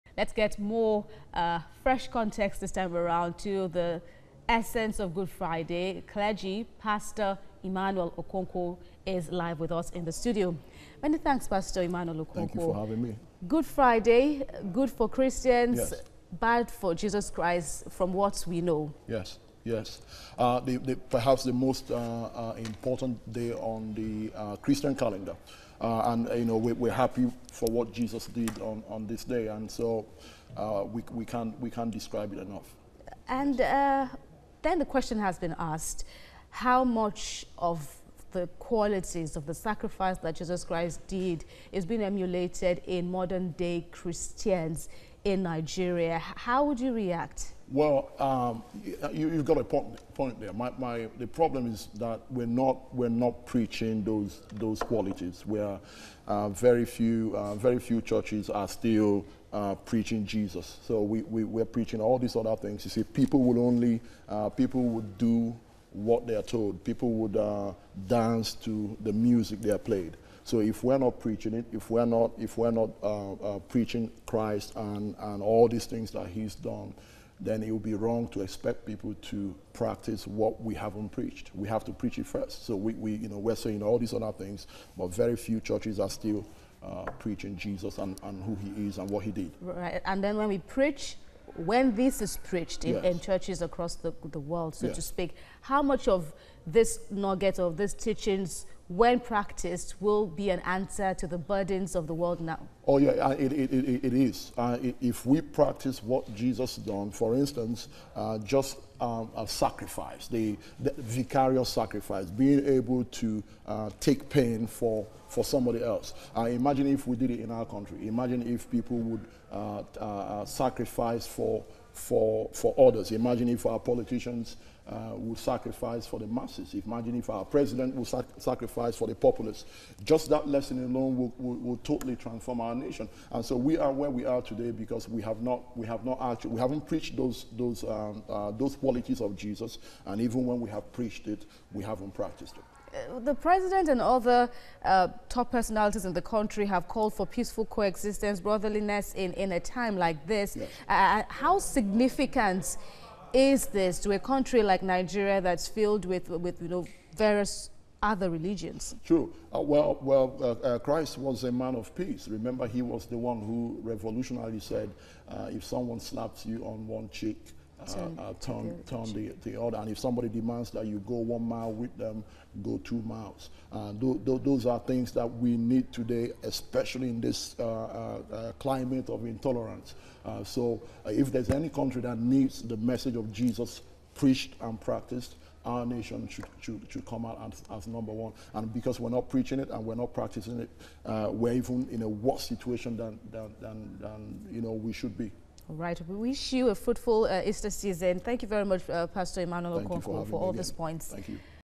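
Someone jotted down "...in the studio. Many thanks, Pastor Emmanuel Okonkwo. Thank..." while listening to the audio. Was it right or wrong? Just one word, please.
right.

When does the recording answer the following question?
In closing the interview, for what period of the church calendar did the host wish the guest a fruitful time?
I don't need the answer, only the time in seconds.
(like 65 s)
197 s.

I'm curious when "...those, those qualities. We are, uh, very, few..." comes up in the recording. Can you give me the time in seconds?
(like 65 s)
54 s.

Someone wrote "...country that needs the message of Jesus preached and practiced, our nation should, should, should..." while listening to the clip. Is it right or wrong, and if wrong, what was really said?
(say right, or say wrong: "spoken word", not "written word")
right.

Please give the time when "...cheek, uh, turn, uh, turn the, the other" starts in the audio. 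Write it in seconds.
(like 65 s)
167 s.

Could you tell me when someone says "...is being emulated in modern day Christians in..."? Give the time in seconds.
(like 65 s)
41 s.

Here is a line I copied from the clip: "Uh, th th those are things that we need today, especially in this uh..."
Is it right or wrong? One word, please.
right.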